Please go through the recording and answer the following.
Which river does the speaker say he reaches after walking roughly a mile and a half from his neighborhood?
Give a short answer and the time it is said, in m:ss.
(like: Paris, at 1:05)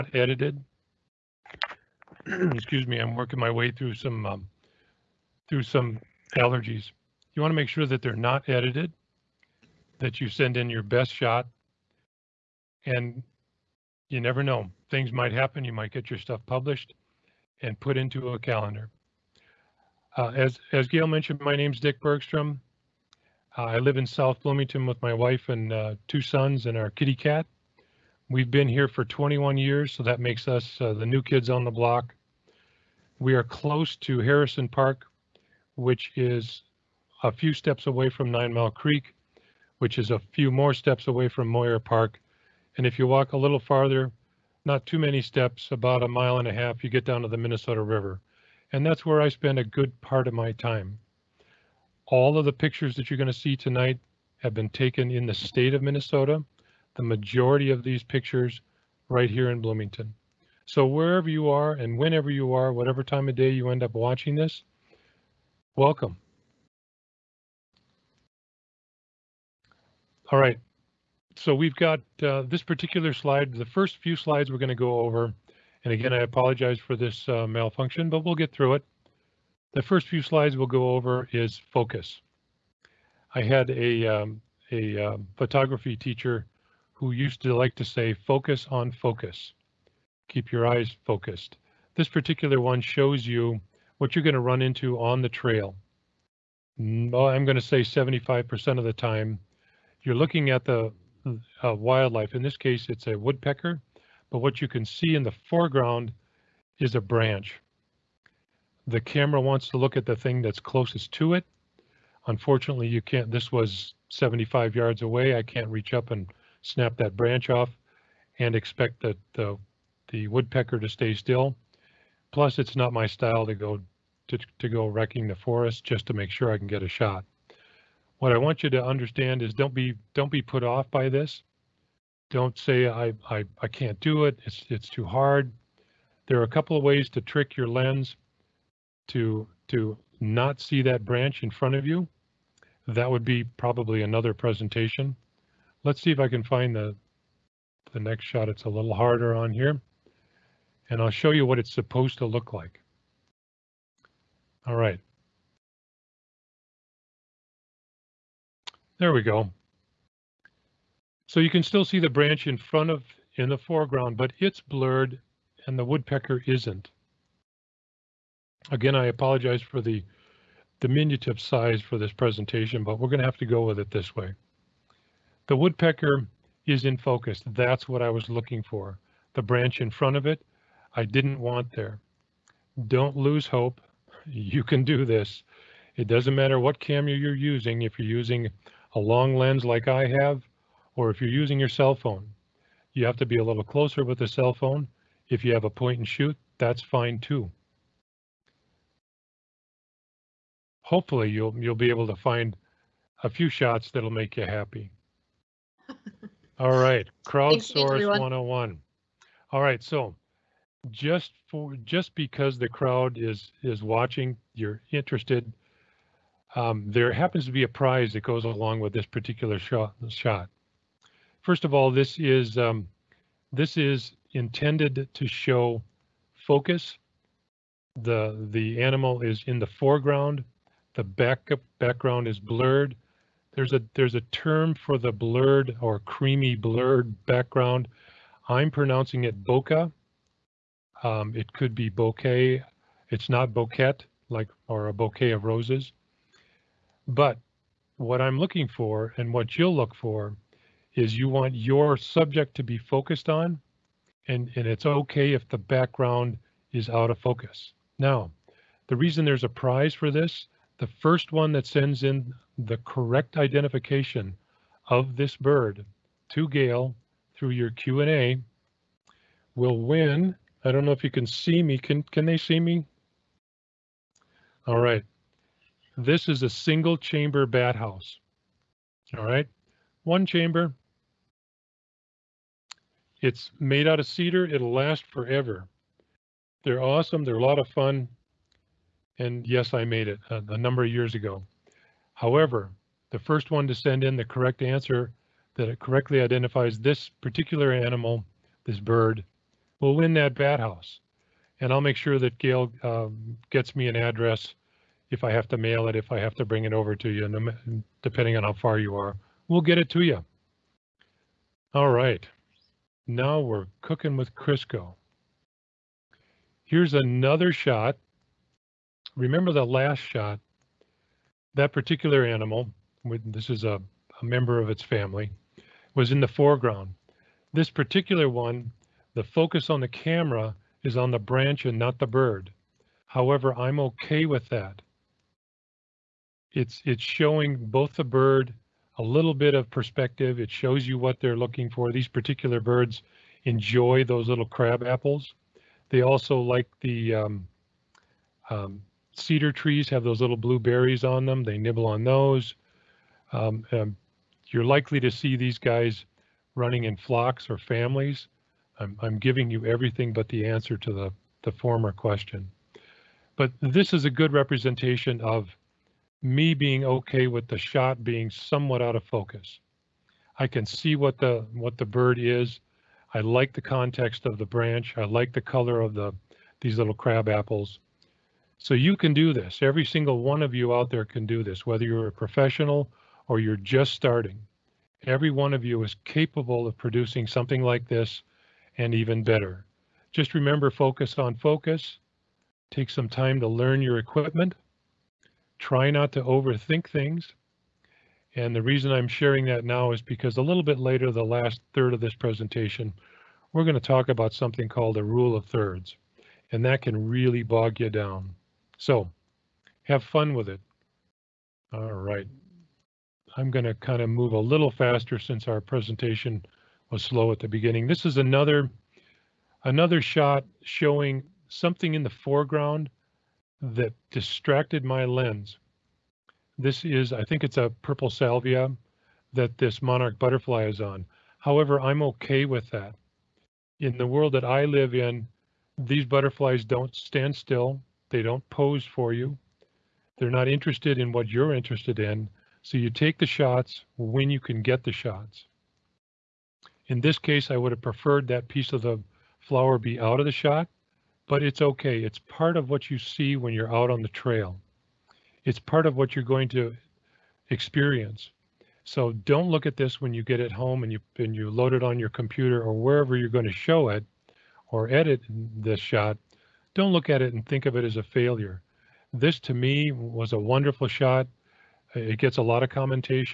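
Minnesota River, at 0:47.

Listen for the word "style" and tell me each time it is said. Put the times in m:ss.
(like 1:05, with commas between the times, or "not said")
2:03.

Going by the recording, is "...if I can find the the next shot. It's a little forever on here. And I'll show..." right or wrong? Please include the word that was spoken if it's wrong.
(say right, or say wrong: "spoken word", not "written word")
wrong: "harder", not "forever".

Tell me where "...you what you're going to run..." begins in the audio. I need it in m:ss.
1:33.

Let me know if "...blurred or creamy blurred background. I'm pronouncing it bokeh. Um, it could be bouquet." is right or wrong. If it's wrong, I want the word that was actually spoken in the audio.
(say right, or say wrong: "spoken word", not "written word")
right.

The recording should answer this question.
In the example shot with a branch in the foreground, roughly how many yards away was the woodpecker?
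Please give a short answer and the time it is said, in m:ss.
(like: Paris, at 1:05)
75, at 1:54.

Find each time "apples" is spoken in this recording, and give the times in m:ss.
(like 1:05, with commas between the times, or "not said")
5:44, 6:17.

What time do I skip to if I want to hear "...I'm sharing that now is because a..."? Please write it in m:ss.
6:38.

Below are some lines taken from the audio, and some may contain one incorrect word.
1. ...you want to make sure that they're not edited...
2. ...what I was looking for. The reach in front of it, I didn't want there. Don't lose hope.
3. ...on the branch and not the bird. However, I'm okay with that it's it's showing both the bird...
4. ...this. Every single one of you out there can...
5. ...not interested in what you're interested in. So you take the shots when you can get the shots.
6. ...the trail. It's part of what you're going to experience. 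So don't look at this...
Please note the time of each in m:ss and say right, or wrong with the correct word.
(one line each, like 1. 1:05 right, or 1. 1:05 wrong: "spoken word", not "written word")
1. 0:07 right
2. 2:57 wrong: "branch", not "reach"
3. 5:30 right
4. 6:19 right
5. 7:20 right
6. 7:34 right.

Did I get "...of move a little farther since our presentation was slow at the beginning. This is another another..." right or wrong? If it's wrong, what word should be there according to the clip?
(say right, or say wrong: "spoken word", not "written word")
wrong: "faster", not "farther".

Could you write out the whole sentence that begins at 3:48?
The the animal is in the foreground.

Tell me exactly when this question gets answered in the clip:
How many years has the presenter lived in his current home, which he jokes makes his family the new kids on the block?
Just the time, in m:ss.
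0:29.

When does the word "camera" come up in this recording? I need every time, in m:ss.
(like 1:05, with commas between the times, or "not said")
1:48, 3:06, 5:29.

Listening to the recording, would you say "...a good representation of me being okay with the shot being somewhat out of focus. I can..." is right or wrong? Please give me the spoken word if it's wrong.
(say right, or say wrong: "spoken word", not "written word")
right.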